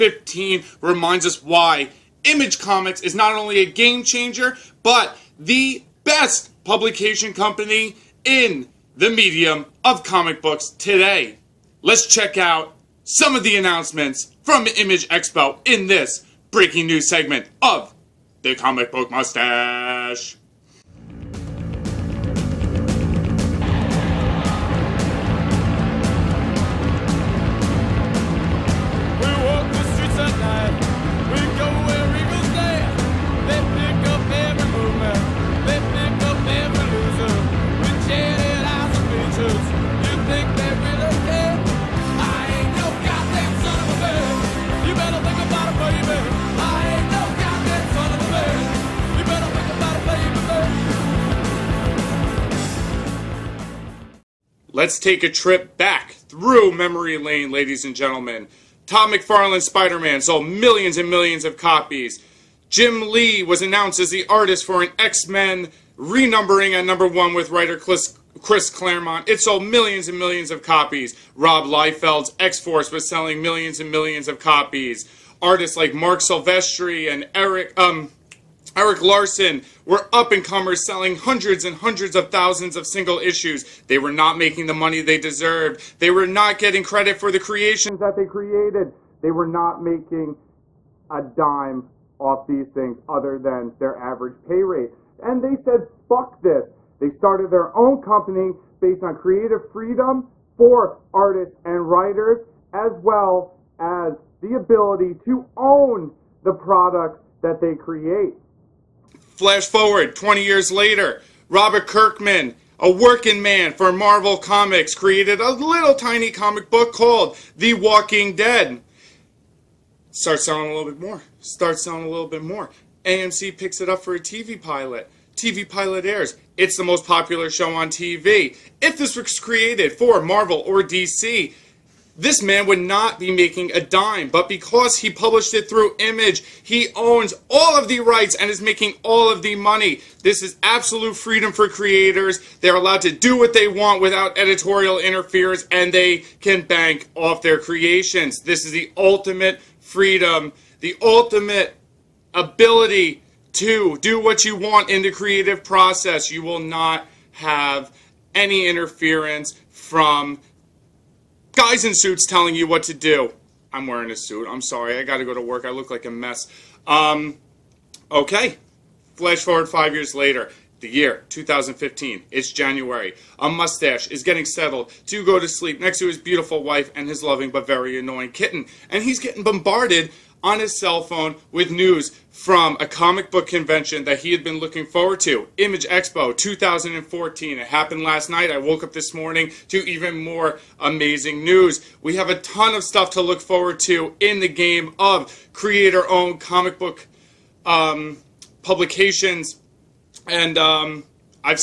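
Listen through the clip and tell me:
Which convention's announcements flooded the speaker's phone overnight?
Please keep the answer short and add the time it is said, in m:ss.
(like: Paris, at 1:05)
Image Expo 2014, at 3:05.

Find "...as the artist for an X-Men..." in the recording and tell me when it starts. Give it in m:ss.
1:04.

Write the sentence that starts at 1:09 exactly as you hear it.
It sold millions and millions of copies.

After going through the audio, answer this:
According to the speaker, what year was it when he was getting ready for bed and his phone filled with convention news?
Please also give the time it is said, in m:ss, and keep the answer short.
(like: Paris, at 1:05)
2015, at 2:50.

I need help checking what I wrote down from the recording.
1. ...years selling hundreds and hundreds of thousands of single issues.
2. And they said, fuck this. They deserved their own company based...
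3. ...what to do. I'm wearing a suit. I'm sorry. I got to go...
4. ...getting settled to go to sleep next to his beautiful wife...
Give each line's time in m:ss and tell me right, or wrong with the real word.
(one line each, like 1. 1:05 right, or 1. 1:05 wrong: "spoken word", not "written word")
1. 1:20 wrong: "comers", not "years"
2. 1:35 wrong: "started", not "deserved"
3. 2:42 right
4. 2:54 right.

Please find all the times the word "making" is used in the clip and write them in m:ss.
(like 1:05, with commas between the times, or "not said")
1:24, 1:29, 2:13, 2:18.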